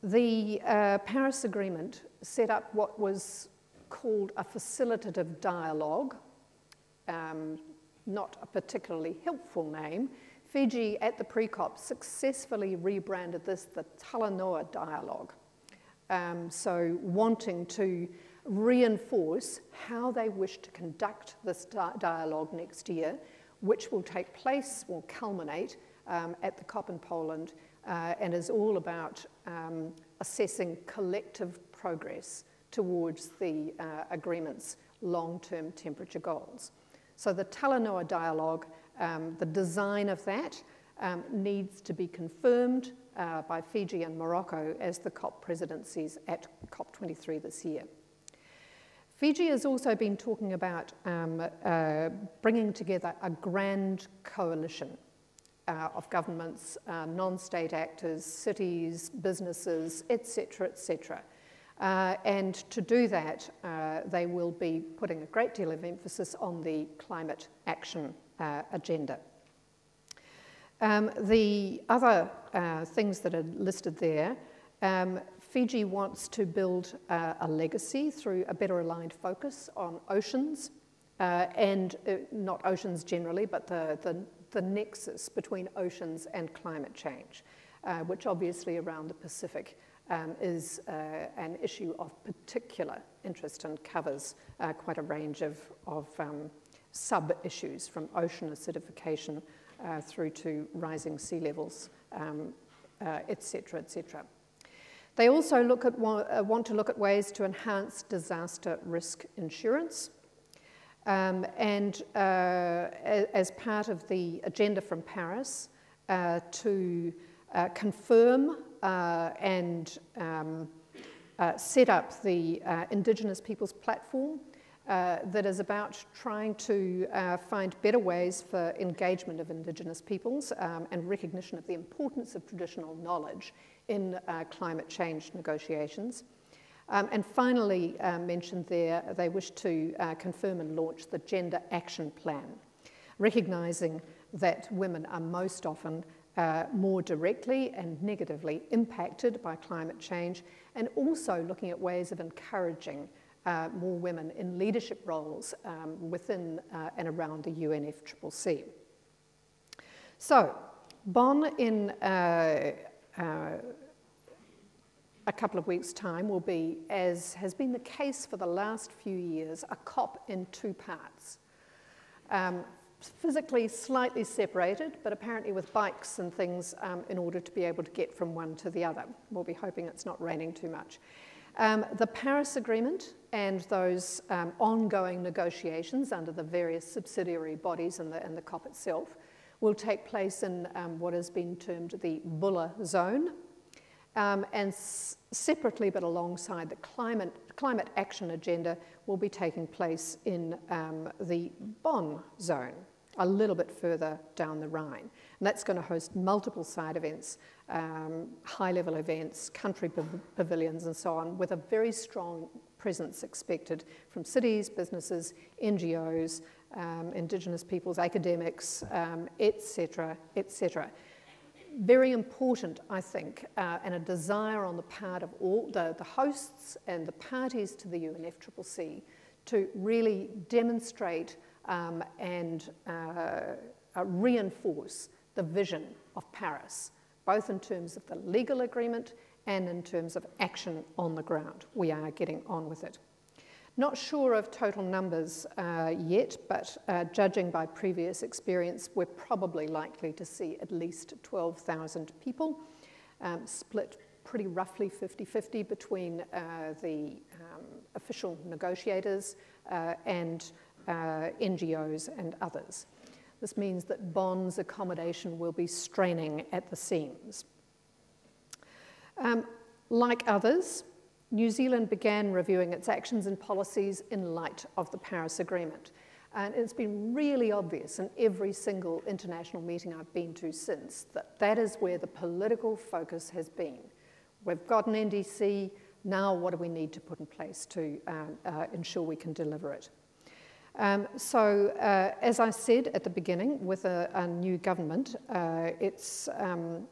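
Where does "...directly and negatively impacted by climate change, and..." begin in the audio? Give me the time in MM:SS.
02:27.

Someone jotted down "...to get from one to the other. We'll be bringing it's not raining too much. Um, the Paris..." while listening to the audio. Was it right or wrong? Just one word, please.
wrong.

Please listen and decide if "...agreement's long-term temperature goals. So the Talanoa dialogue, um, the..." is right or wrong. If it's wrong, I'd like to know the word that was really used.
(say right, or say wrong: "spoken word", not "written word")
right.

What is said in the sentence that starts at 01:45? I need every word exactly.
They also look at, uh, want to look at ways to enhance disaster risk insurance.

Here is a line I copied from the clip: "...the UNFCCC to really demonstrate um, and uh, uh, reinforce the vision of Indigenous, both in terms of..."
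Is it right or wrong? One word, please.
wrong.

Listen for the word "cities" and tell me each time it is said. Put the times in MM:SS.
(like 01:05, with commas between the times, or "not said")
00:58, 03:34.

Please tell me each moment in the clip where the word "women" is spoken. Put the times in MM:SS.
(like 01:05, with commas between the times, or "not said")
02:24, 02:33.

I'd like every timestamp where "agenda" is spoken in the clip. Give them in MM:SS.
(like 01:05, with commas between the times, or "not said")
01:08, 01:54, 03:18.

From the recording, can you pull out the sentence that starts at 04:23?
This means that Bonn's accommodation will be straining at the seams.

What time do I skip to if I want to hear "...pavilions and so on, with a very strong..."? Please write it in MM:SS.
03:30.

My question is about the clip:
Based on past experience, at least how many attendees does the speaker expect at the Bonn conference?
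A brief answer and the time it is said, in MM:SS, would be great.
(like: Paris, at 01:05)
12,000, at 04:11.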